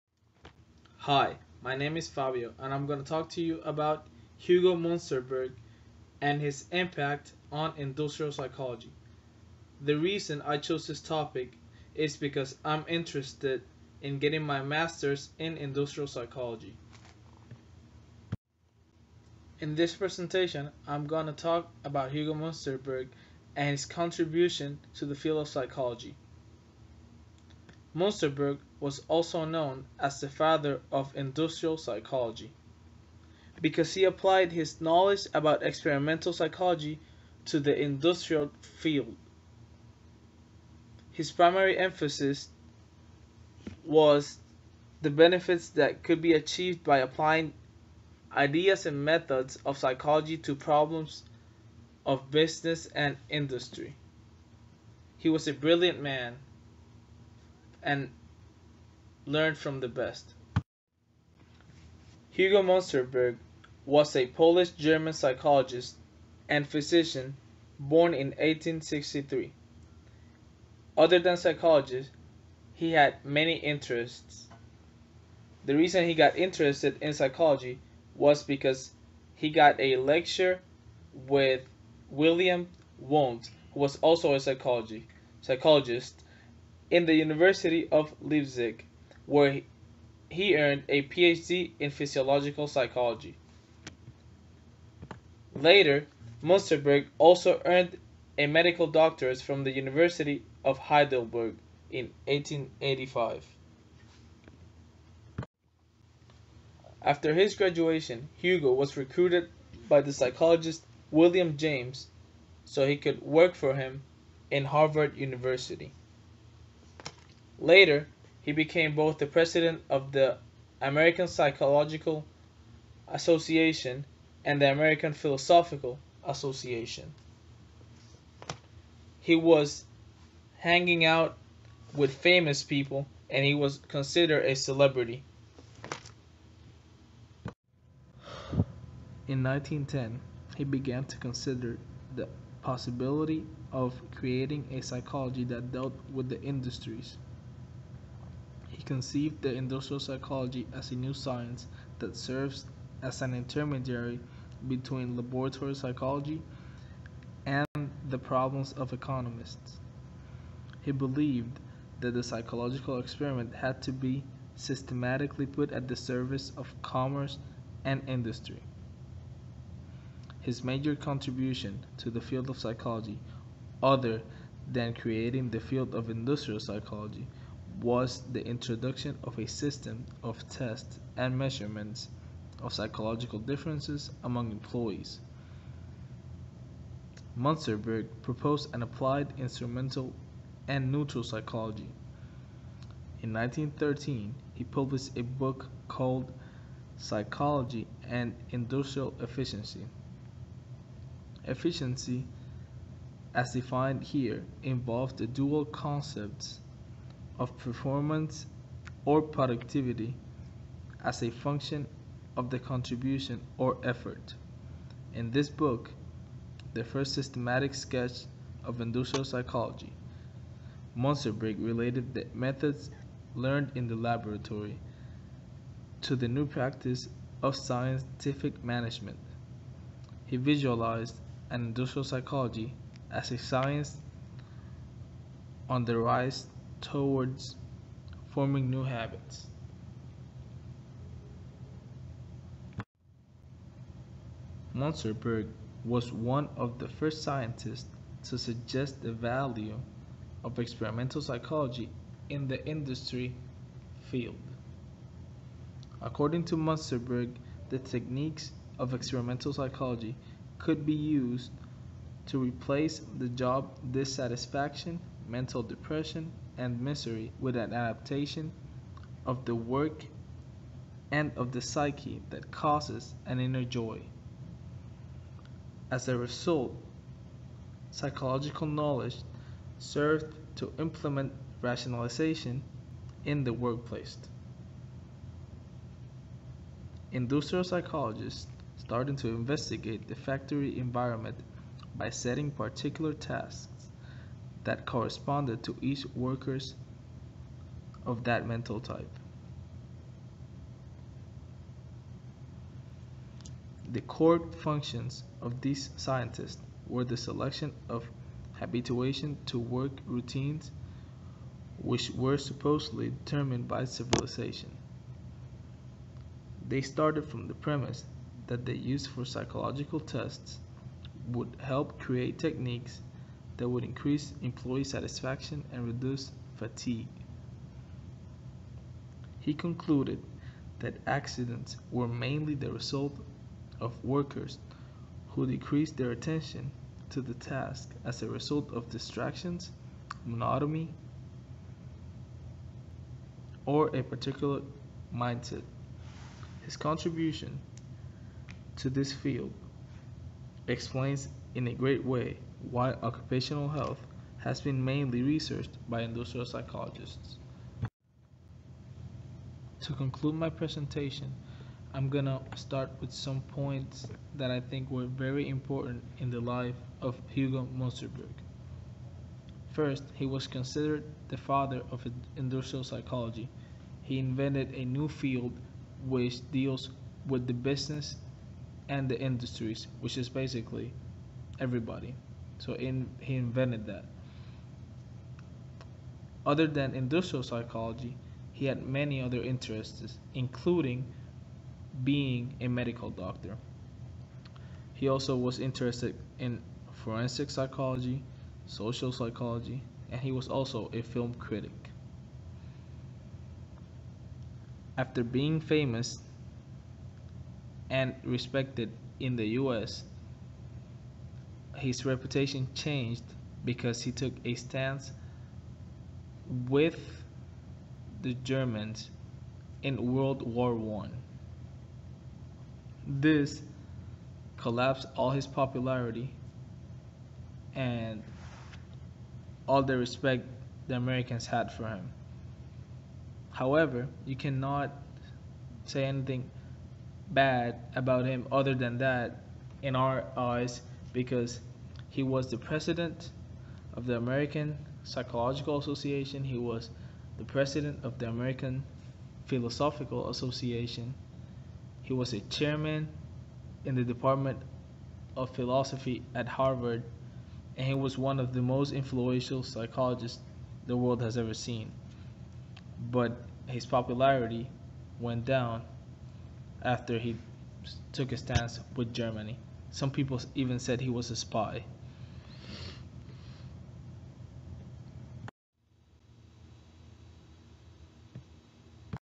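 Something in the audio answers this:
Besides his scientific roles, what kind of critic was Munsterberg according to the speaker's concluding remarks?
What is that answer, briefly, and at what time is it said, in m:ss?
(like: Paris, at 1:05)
film critic, at 6:41.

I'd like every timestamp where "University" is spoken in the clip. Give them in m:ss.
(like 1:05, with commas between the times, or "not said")
1:27, 1:39, 1:55.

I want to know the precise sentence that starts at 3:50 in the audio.
He visualized an industrial psychology as a science on the rise towards forming new habits.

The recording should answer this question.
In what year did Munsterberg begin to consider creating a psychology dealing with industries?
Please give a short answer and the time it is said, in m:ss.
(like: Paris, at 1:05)
1910, at 2:19.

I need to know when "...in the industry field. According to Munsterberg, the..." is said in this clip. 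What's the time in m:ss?
4:12.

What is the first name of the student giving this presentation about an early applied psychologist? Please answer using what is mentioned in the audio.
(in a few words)
Fabio.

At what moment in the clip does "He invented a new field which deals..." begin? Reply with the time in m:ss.
6:14.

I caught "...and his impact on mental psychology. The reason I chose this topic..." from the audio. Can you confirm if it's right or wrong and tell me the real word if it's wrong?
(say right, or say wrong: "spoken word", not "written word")
wrong: "industrial", not "mental".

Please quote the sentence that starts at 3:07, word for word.
Munsterberg proposed an applied instrumental and neutral psychology.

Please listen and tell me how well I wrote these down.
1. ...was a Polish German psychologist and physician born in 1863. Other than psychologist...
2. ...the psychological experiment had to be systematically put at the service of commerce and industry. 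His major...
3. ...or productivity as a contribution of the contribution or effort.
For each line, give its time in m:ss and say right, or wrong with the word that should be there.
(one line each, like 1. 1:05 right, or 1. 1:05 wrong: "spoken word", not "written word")
1. 1:03 right
2. 2:42 right
3. 3:29 wrong: "function", not "contribution".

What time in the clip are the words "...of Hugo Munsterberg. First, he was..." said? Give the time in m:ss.
6:07.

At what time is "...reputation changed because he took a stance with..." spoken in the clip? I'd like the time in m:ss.
6:52.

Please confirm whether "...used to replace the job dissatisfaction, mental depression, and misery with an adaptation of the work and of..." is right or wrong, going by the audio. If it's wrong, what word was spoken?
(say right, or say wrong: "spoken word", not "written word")
right.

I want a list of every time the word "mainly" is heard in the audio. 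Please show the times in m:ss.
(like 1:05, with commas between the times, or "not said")
5:32, 5:54.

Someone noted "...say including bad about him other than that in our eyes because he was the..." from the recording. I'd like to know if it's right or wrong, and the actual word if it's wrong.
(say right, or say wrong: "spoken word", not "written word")
wrong: "anything", not "including".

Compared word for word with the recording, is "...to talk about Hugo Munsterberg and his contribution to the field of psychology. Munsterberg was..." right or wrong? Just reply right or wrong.
right.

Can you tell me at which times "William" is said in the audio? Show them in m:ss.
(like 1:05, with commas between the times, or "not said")
1:22, 1:51.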